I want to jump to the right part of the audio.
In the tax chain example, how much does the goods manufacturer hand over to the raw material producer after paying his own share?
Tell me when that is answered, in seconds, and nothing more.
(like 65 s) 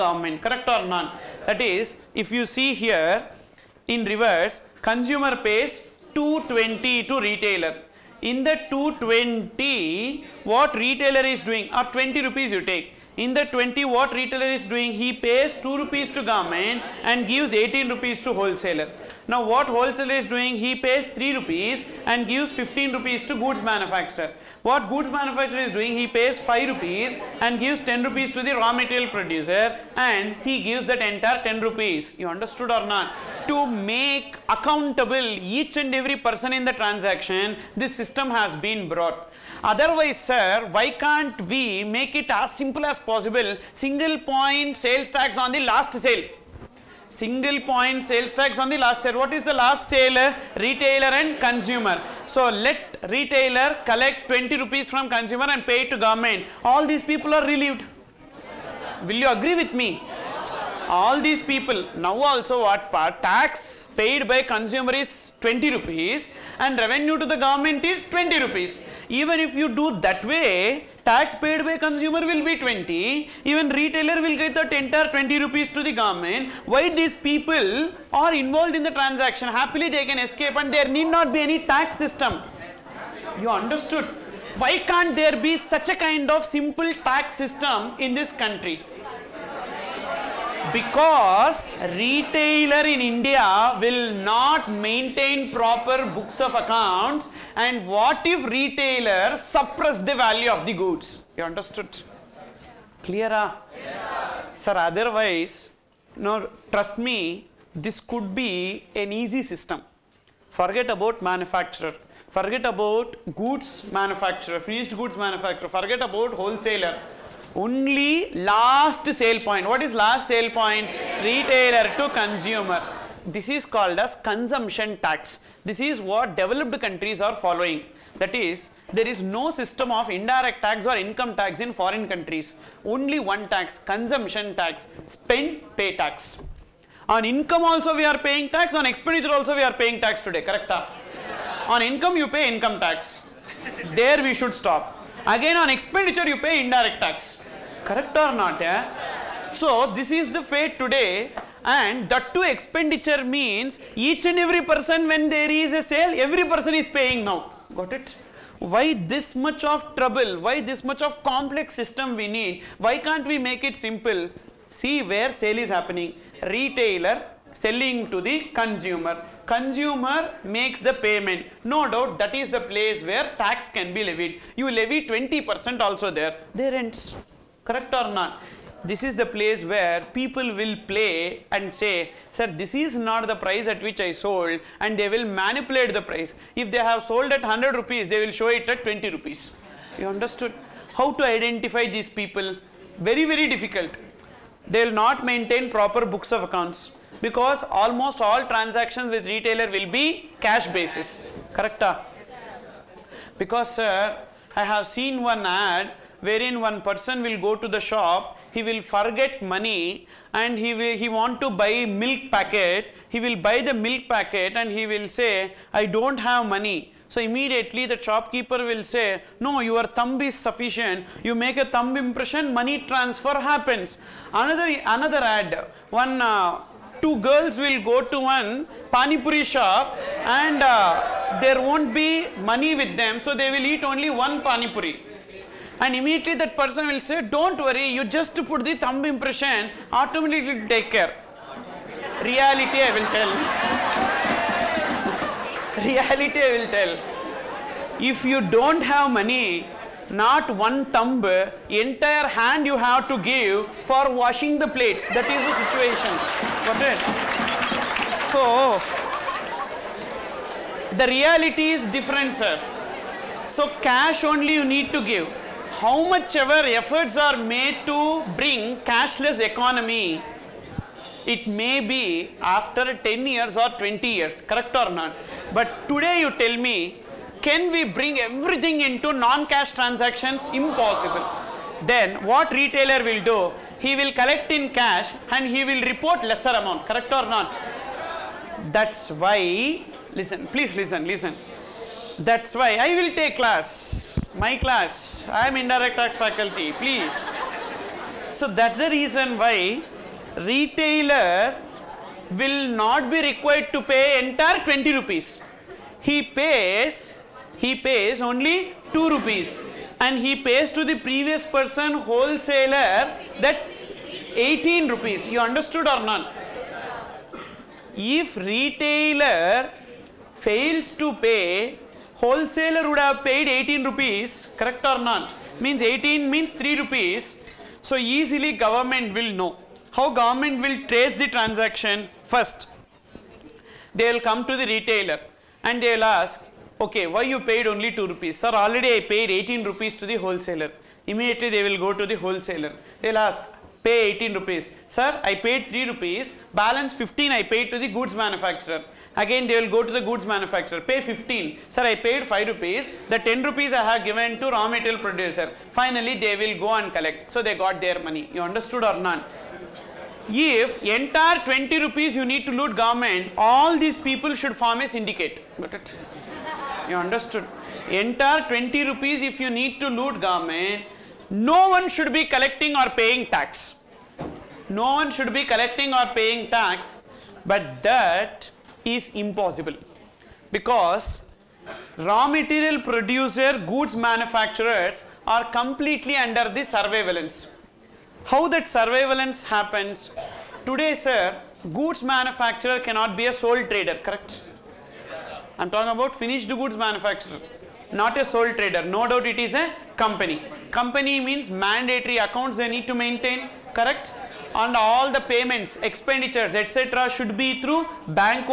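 27 s.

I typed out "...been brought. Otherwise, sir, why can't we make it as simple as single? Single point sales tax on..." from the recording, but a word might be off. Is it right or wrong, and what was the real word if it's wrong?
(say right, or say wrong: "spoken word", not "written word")
wrong: "possible", not "single".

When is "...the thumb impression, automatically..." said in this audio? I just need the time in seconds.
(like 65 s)
238 s.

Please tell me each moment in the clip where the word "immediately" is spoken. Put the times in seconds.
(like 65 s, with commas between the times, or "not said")
217 s, 235 s, 341 s.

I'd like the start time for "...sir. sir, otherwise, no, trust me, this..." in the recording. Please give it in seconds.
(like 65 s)
104 s.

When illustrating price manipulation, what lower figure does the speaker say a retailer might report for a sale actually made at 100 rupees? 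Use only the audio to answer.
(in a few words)
20 rupees.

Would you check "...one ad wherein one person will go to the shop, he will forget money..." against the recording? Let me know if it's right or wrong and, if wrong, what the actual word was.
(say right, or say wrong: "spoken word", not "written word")
right.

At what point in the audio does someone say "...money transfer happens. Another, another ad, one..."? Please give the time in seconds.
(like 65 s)
222 s.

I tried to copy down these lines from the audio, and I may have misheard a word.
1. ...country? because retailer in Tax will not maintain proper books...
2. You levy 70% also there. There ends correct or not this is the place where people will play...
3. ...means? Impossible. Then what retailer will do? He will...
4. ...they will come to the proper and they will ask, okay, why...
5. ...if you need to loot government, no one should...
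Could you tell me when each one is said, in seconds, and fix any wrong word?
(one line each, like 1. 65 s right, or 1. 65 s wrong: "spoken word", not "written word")
1. 88 s wrong: "India", not "Tax"
2. 174 s wrong: "20", not "70"
3. 279 s wrong: "transactions", not "means"
4. 333 s wrong: "retailer", not "proper"
5. 369 s right.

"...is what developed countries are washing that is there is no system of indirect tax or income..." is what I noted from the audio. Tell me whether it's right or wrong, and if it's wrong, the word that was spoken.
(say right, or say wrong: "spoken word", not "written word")
wrong: "following", not "washing".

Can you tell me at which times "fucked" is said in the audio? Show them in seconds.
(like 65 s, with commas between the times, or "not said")
not said.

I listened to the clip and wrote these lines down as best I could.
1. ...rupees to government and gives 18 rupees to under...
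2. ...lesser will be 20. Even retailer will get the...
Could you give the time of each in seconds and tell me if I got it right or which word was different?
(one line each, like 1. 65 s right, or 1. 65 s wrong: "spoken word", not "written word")
1. 15 s wrong: "wholesaler", not "under"
2. 71 s wrong: "consumer", not "lesser".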